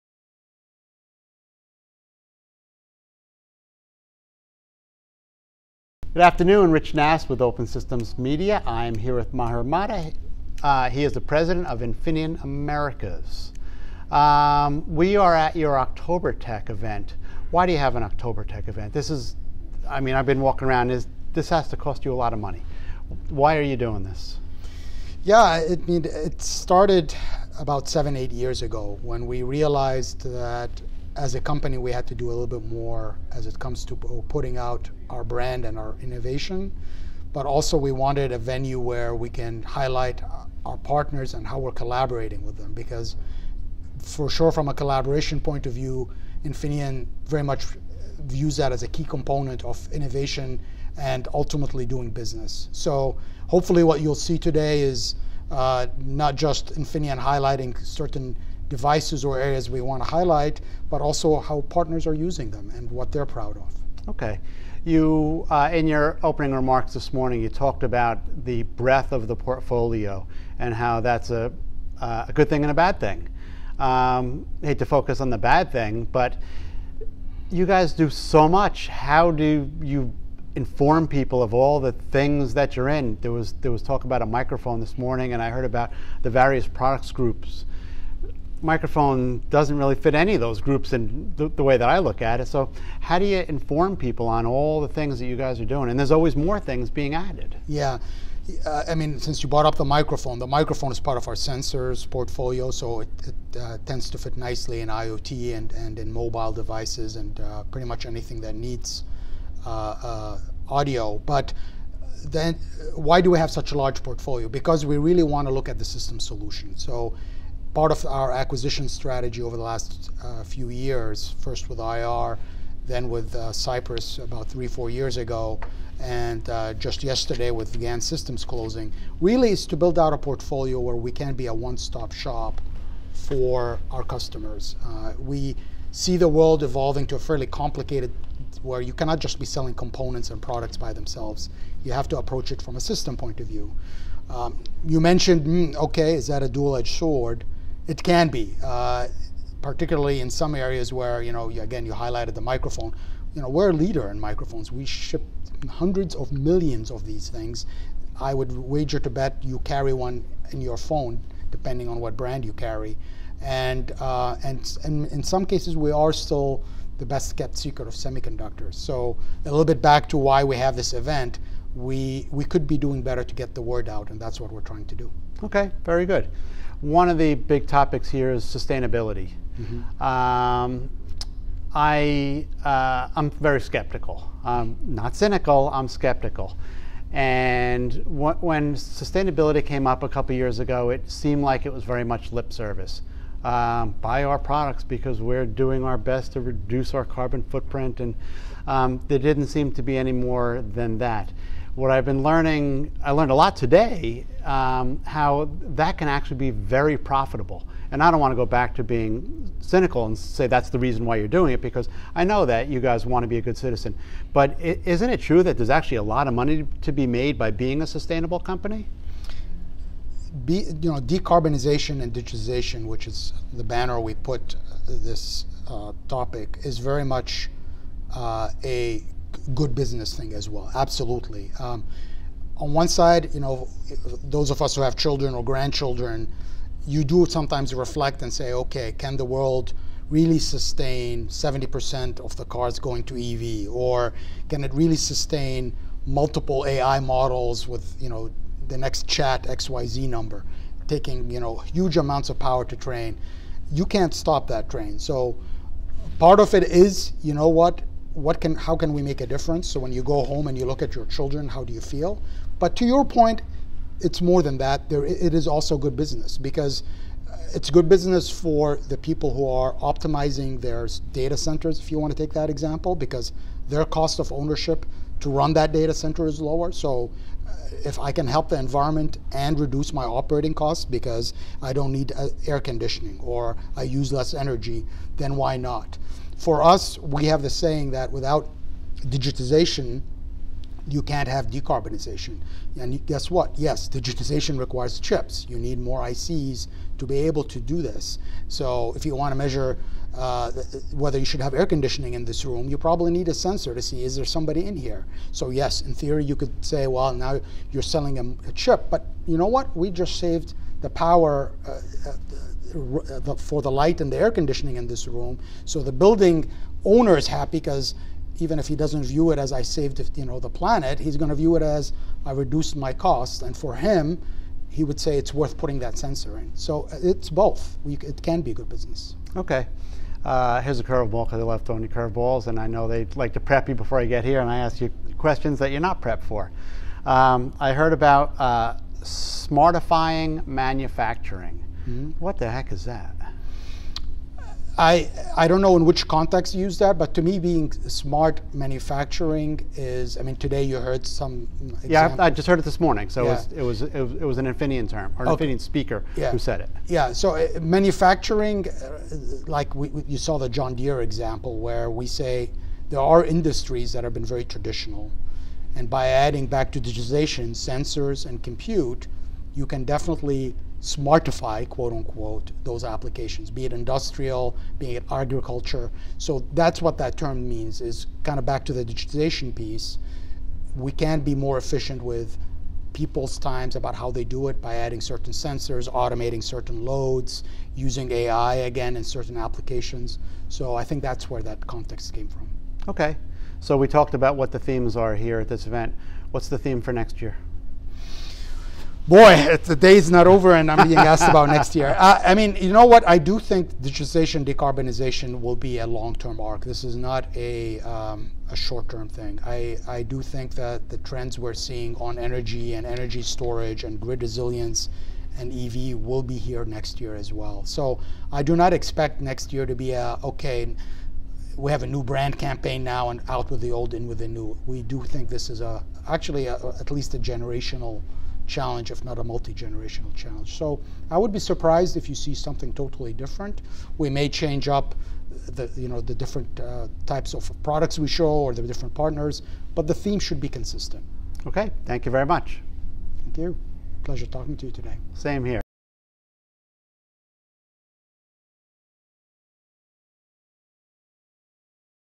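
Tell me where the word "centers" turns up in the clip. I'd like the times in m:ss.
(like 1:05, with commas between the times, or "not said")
4:31, 4:35.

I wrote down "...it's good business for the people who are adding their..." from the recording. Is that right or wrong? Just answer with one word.
wrong.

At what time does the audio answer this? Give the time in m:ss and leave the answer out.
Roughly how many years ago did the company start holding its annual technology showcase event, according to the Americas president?
0:27.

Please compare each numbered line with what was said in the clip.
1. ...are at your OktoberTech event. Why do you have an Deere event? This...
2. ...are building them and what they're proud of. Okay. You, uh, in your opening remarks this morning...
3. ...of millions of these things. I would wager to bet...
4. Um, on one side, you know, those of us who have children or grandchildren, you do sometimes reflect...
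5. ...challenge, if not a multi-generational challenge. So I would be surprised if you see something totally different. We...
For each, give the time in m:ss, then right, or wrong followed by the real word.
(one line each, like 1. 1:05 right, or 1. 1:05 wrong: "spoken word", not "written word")
1. 0:15 wrong: "OktoberTech", not "Deere"
2. 1:02 wrong: "using", not "building"
3. 2:36 right
4. 3:51 right
5. 7:08 right.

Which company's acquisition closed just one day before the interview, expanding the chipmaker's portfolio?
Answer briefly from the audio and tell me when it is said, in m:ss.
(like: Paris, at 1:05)
GaN Systems, at 2:07.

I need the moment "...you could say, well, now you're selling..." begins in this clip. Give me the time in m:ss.
5:06.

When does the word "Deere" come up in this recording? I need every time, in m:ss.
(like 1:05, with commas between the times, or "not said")
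6:00.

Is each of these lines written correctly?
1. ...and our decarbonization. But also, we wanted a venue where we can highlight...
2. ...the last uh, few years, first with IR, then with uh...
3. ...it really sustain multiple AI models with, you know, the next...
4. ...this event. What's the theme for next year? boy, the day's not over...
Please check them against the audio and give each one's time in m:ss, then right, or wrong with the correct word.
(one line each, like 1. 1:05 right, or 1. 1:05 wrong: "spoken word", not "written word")
1. 0:35 wrong: "innovation", not "decarbonization"
2. 1:59 right
3. 4:04 right
4. 6:35 right.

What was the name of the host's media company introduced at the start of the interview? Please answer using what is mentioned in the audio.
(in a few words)
Open Systems Media.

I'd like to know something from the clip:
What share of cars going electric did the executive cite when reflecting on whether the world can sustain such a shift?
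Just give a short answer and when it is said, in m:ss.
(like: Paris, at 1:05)
70%, at 4:01.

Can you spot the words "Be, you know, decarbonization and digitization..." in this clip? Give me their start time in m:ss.
3:40.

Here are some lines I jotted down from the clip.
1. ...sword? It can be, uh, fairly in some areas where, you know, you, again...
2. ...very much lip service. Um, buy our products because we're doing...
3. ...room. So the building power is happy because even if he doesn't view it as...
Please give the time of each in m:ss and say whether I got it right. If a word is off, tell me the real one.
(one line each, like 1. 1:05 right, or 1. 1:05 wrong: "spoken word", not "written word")
1. 2:26 wrong: "particularly", not "fairly"
2. 3:11 right
3. 5:15 wrong: "owner", not "power".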